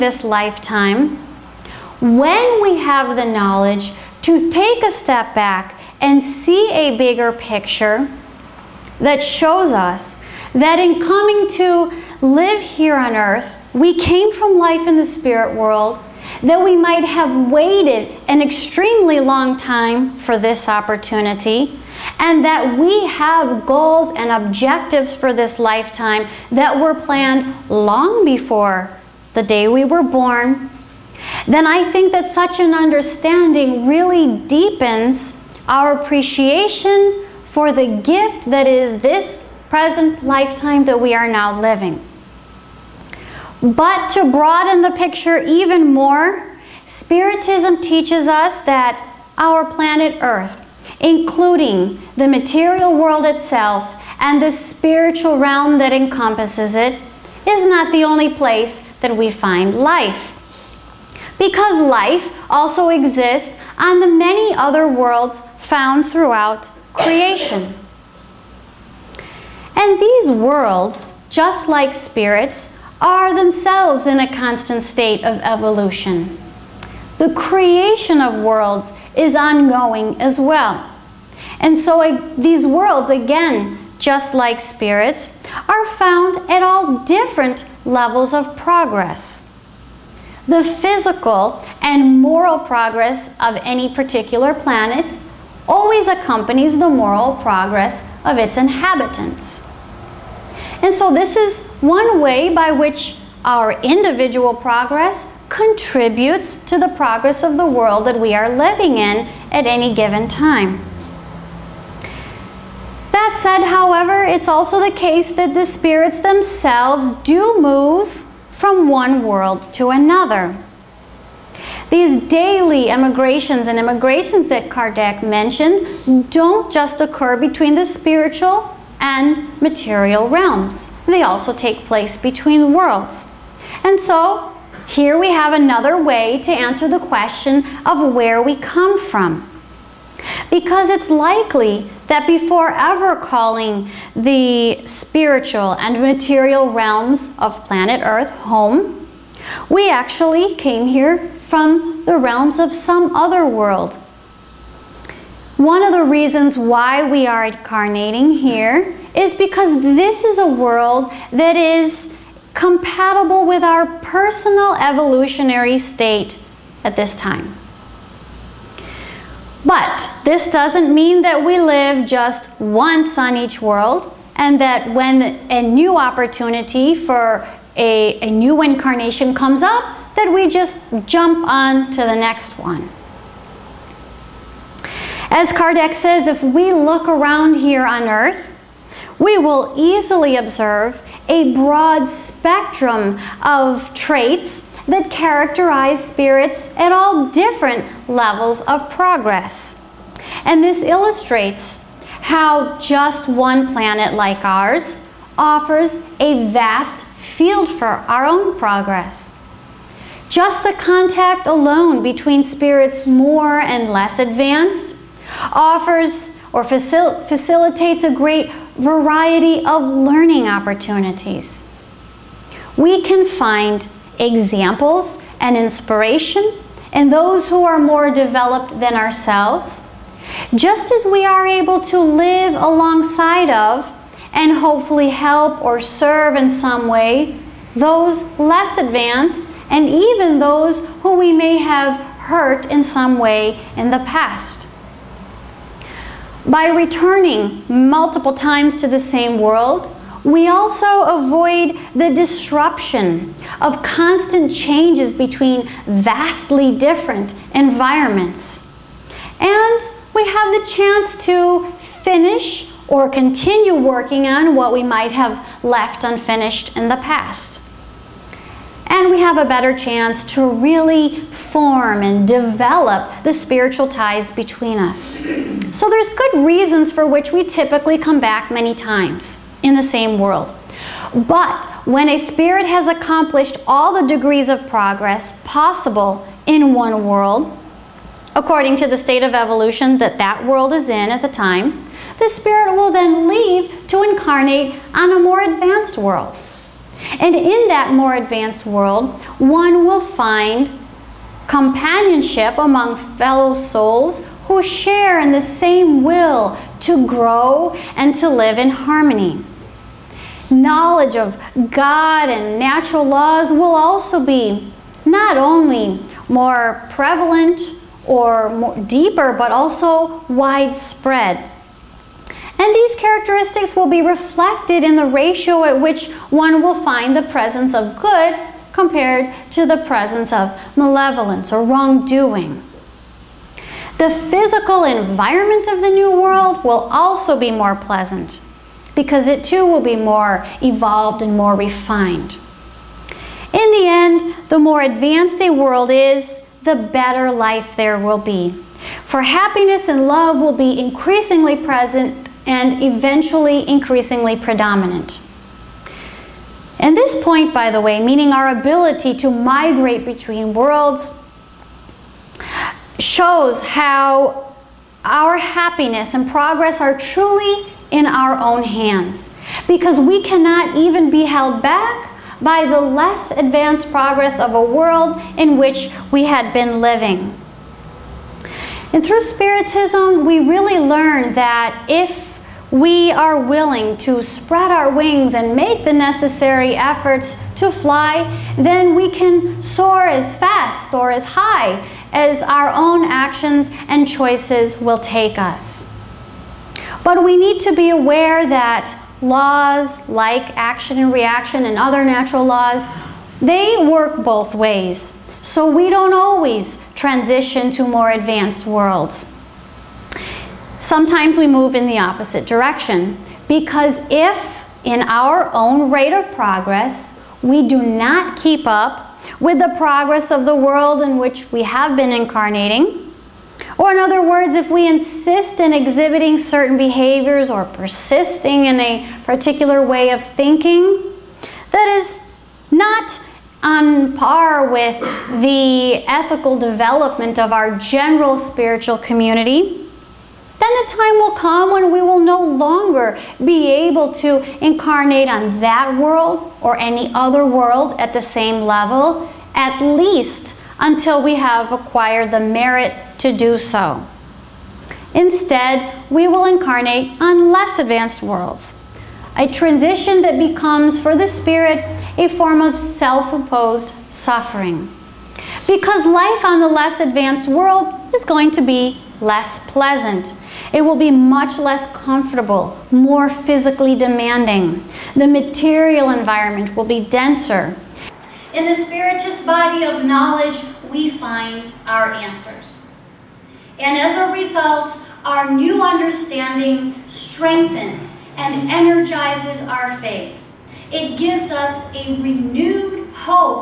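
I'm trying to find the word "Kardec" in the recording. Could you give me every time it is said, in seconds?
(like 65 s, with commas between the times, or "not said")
124 s, 185 s.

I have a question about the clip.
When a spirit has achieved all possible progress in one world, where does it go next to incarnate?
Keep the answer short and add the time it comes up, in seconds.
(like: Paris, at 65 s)
a more advanced world, at 295 s.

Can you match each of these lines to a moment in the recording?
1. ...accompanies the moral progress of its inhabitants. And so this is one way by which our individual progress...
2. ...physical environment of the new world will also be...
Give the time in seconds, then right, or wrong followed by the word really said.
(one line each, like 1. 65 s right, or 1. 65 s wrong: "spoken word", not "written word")
1. 96 s right
2. 334 s right.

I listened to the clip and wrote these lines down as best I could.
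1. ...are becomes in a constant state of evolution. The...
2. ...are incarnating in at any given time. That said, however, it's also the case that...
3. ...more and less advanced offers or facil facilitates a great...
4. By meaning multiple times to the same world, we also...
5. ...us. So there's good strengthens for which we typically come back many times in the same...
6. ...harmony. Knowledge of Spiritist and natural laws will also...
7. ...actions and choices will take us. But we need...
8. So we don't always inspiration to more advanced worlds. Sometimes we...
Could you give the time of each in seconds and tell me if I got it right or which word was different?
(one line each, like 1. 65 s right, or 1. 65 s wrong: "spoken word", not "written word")
1. 73 s wrong: "themselves", not "becomes"
2. 108 s wrong: "living", not "incarnating"
3. 213 s right
4. 246 s wrong: "returning", not "meaning"
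5. 274 s wrong: "reasons", not "strengthens"
6. 308 s wrong: "God", not "Spiritist"
7. 393 s right
8. 405 s wrong: "transition", not "inspiration".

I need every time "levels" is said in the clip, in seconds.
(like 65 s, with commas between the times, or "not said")
87 s, 198 s, 448 s.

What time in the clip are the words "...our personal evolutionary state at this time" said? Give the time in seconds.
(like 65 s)
163 s.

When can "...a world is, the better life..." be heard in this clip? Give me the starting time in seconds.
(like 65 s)
345 s.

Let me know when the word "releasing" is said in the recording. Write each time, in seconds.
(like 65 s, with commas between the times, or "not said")
not said.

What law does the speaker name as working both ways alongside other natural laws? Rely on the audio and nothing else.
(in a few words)
action and reaction.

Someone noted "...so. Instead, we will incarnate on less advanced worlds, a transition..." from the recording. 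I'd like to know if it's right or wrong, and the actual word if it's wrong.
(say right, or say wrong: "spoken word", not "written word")
right.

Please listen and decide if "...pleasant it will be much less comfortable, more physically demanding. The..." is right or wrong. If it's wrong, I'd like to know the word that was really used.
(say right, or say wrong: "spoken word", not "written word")
right.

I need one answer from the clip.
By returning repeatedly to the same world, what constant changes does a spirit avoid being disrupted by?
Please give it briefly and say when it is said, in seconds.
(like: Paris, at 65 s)
vastly different environments, at 255 s.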